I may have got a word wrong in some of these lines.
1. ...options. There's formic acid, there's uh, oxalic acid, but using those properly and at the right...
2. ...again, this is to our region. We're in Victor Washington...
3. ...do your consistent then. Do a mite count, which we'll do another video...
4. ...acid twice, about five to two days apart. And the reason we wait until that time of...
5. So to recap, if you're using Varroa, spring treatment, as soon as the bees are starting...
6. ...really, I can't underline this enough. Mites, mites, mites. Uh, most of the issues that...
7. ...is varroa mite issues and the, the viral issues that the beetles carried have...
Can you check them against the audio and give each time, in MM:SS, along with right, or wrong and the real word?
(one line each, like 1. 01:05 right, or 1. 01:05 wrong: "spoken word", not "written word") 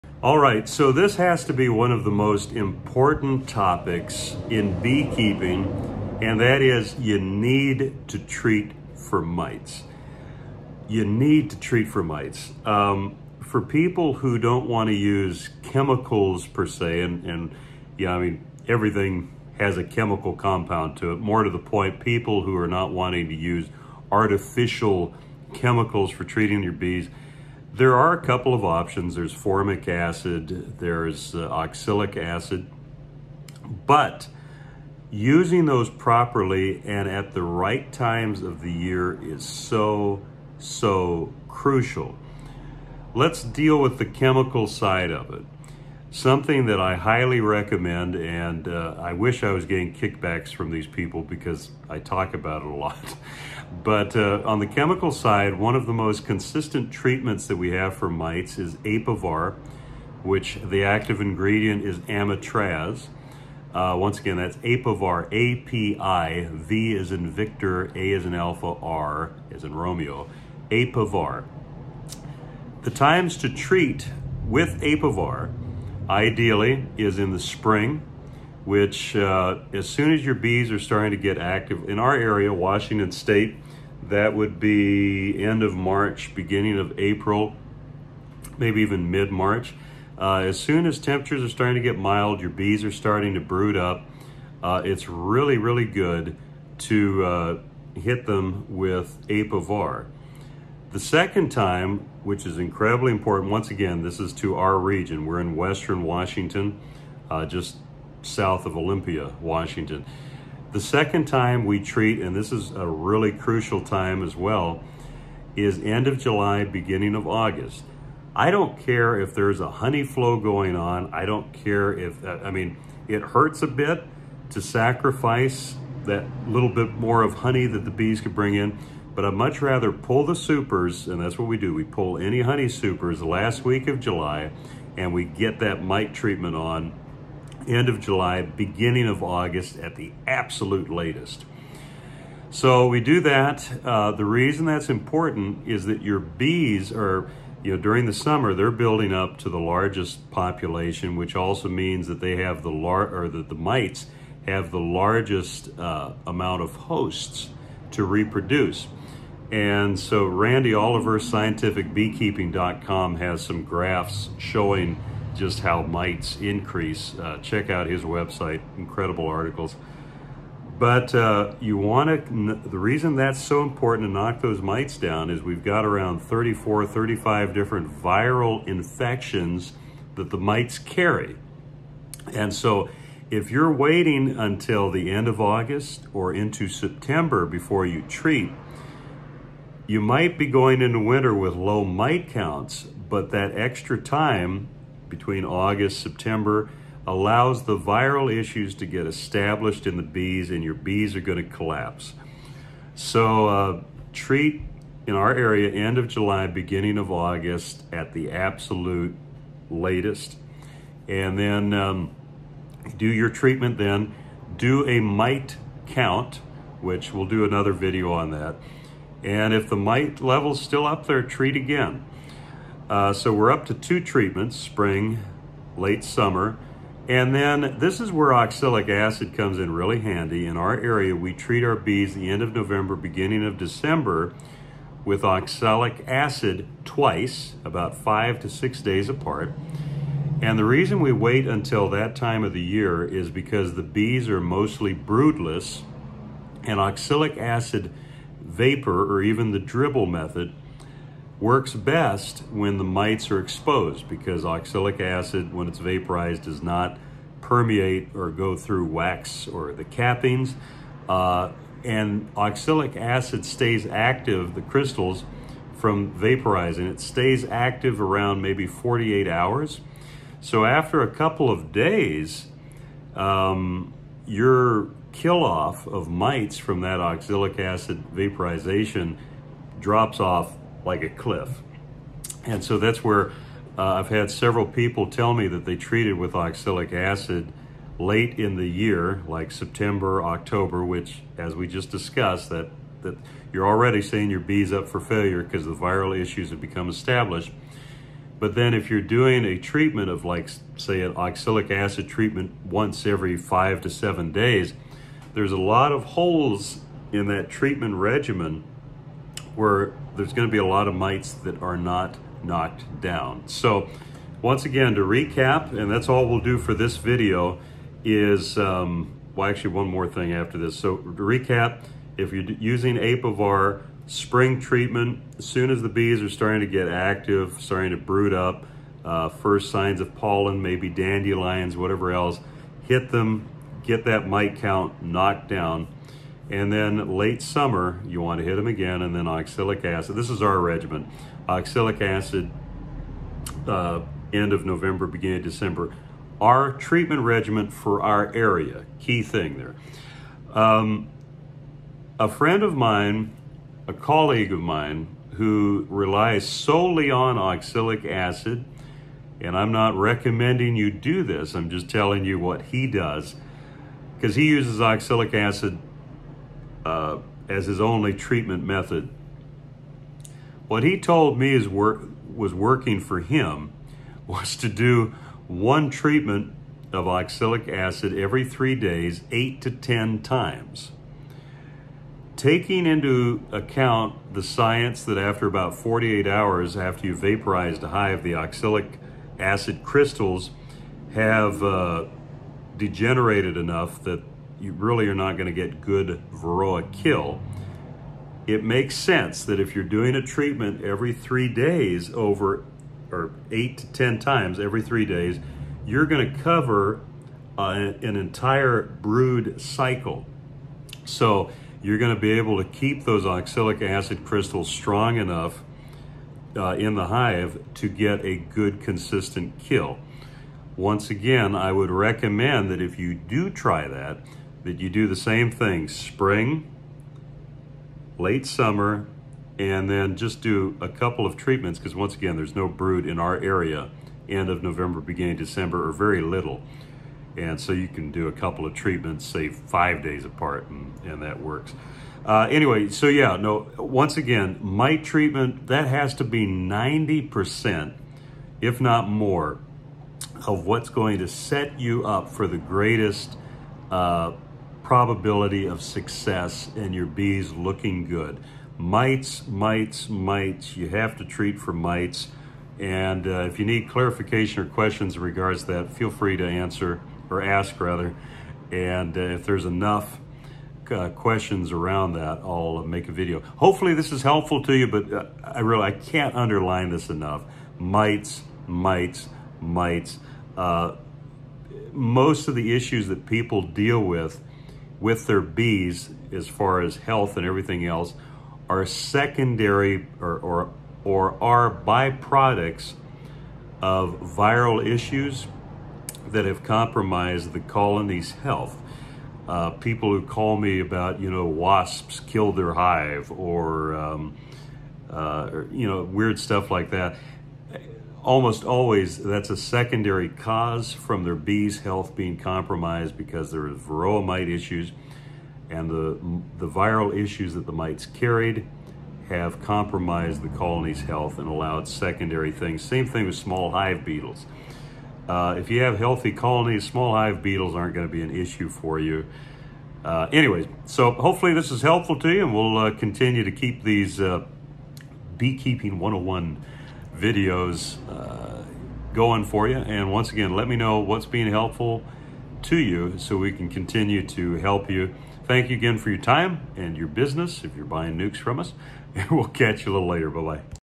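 1. 00:28 right
2. 01:43 wrong: "Western", not "Victor"
3. 03:32 wrong: "treatment", not "consistent"
4. 03:56 wrong: "six", not "two"
5. 05:20 wrong: "Apivar", not "Varroa"
6. 07:55 right
7. 08:33 wrong: "mites", not "beetles".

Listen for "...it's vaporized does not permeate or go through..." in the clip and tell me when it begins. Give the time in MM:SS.
04:15.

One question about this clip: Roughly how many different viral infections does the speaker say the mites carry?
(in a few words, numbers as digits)
34 or 35.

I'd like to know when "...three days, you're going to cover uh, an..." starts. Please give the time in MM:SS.
06:44.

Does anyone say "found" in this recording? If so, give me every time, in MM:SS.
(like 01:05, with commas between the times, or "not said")
not said.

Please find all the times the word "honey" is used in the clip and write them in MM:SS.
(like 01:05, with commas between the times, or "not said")
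01:59, 02:07, 02:12.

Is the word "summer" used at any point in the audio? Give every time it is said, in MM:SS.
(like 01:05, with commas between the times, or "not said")
02:28, 03:46, 05:37, 07:08.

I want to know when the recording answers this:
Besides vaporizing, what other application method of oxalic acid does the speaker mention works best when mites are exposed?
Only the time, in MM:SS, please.
04:09.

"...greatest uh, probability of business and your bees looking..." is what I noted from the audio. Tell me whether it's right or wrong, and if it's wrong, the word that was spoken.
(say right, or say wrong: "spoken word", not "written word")
wrong: "success", not "business".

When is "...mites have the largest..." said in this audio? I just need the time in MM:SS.
02:33.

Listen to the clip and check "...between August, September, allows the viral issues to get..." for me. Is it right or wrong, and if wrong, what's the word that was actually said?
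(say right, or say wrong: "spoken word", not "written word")
right.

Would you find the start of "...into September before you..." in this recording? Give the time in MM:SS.
03:06.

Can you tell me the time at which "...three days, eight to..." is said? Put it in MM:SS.
06:18.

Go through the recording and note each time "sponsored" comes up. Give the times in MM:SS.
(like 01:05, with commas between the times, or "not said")
not said.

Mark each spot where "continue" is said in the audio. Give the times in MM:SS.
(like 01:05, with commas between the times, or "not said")
08:52, 09:03.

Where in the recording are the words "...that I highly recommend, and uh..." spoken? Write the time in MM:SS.
00:46.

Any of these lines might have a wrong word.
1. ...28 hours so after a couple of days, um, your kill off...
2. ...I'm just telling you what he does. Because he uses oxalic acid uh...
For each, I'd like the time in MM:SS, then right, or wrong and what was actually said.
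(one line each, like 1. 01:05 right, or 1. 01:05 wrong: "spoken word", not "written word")
1. 04:28 wrong: "48", not "28"
2. 06:01 right.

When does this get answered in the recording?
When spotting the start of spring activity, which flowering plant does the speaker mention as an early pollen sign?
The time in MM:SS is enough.
05:30.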